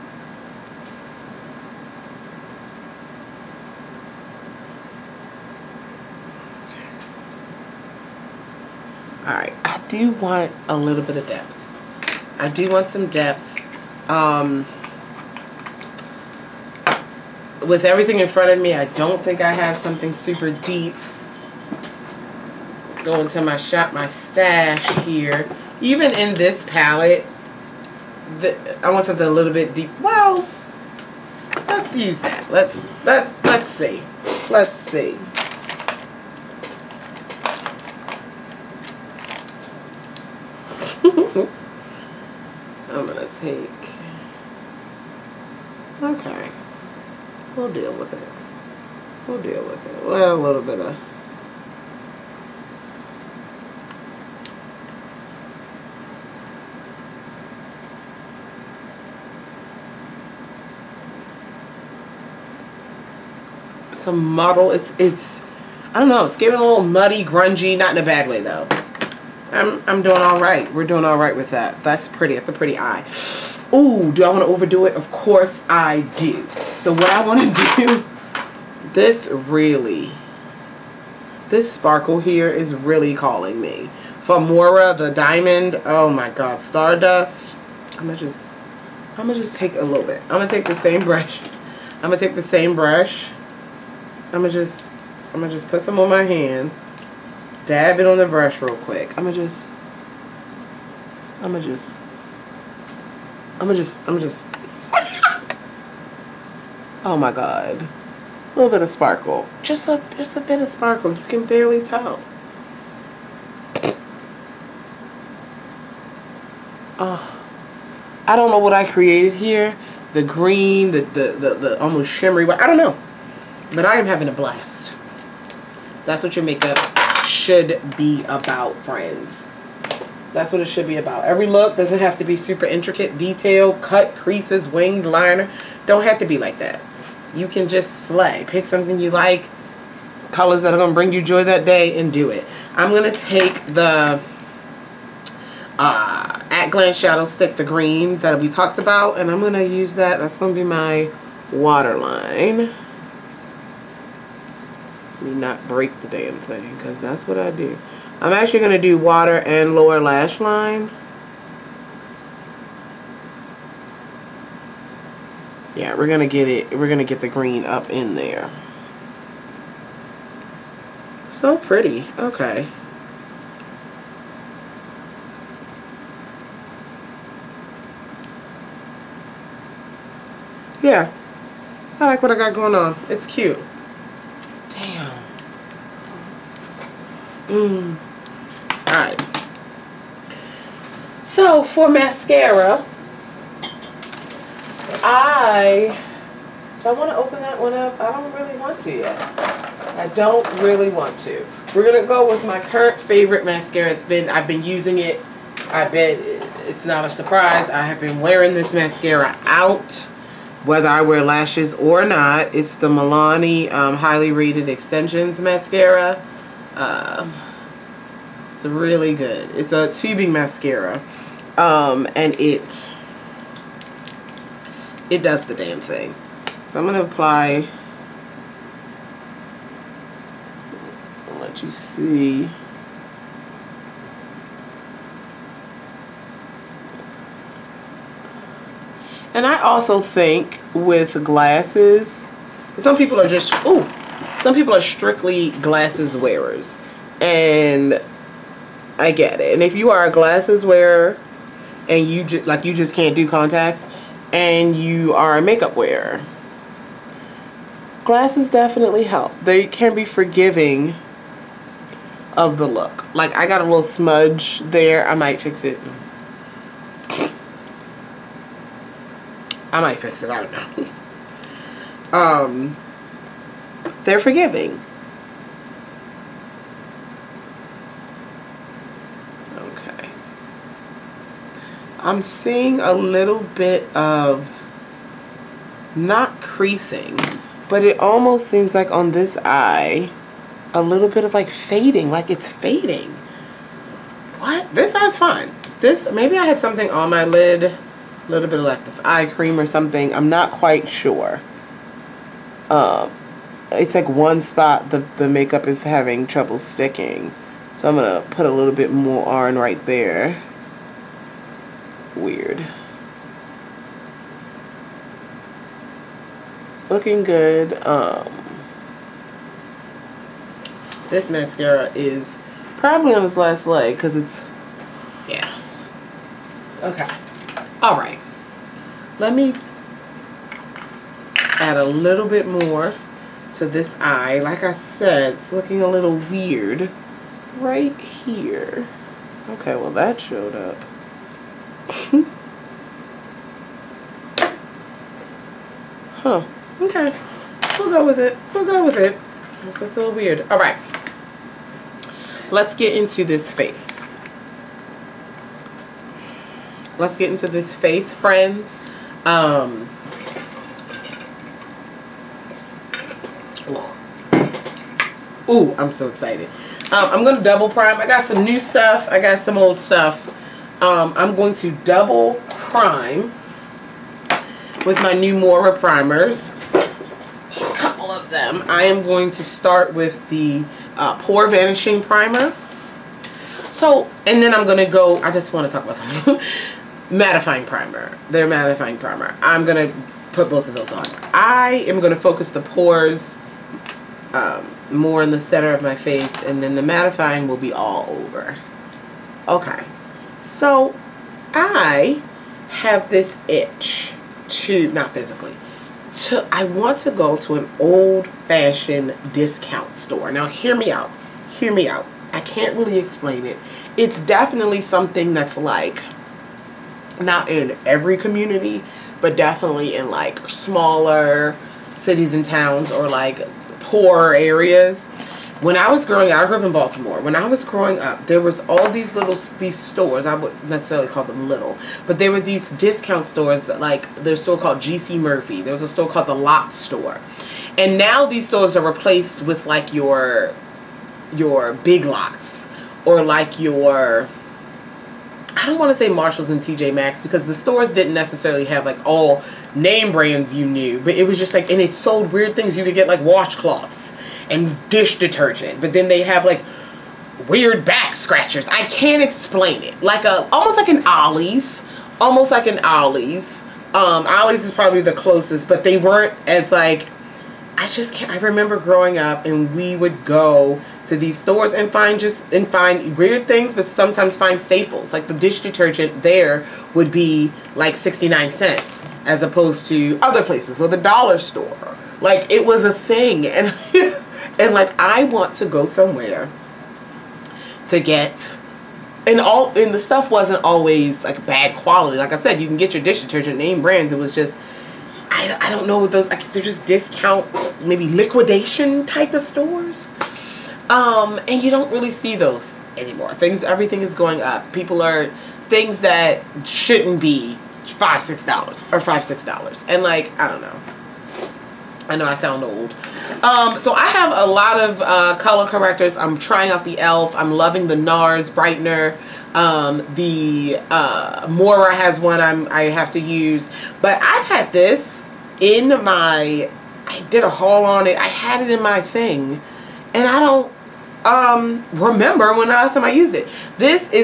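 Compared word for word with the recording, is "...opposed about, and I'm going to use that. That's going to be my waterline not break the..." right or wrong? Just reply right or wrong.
wrong.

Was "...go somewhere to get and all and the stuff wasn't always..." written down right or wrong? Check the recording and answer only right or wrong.
right.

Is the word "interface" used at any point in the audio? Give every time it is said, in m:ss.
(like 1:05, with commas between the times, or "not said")
not said.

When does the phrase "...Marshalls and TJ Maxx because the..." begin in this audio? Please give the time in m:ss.
7:26.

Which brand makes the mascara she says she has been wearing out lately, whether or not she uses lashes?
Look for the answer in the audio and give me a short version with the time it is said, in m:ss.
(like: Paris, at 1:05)
Milani, at 3:32.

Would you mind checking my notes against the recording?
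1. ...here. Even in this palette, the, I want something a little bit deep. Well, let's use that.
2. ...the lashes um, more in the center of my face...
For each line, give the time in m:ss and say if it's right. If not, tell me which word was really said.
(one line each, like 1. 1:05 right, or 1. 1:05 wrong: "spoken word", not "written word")
1. 0:25 right
2. 6:32 wrong: "pores", not "lashes".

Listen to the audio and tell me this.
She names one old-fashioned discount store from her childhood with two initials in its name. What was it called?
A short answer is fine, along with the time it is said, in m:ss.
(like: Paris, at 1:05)
GC Murphy, at 7:14.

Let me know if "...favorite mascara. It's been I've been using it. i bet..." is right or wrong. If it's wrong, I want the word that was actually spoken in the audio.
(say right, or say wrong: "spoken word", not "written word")
right.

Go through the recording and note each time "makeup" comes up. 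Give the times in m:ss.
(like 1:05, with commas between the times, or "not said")
2:06, 4:15, 5:05.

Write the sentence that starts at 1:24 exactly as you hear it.
Famora the diamond, oh my god, Stardust.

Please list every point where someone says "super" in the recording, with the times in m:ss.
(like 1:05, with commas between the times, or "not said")
0:20, 2:12.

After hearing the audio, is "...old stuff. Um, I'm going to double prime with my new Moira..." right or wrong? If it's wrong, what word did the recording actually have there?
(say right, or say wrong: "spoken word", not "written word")
right.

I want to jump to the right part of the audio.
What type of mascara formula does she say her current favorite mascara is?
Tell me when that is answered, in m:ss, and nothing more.
3:39.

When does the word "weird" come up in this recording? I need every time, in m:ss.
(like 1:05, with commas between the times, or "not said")
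5:12, 5:36, 5:50, 7:32, 7:37, 7:53.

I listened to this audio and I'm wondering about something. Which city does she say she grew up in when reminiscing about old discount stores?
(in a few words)
Baltimore.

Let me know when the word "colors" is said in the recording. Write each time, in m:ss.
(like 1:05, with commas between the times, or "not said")
2:20, 8:35.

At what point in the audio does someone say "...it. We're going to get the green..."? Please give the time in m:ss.
2:46.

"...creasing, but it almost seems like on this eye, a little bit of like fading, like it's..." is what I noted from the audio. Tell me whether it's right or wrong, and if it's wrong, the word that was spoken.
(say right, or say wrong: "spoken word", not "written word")
right.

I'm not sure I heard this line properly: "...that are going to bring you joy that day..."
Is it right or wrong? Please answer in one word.
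right.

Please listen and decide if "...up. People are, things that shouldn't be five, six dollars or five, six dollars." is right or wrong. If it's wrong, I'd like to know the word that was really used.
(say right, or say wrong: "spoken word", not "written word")
right.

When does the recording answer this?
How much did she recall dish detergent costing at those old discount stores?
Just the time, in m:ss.
7:57.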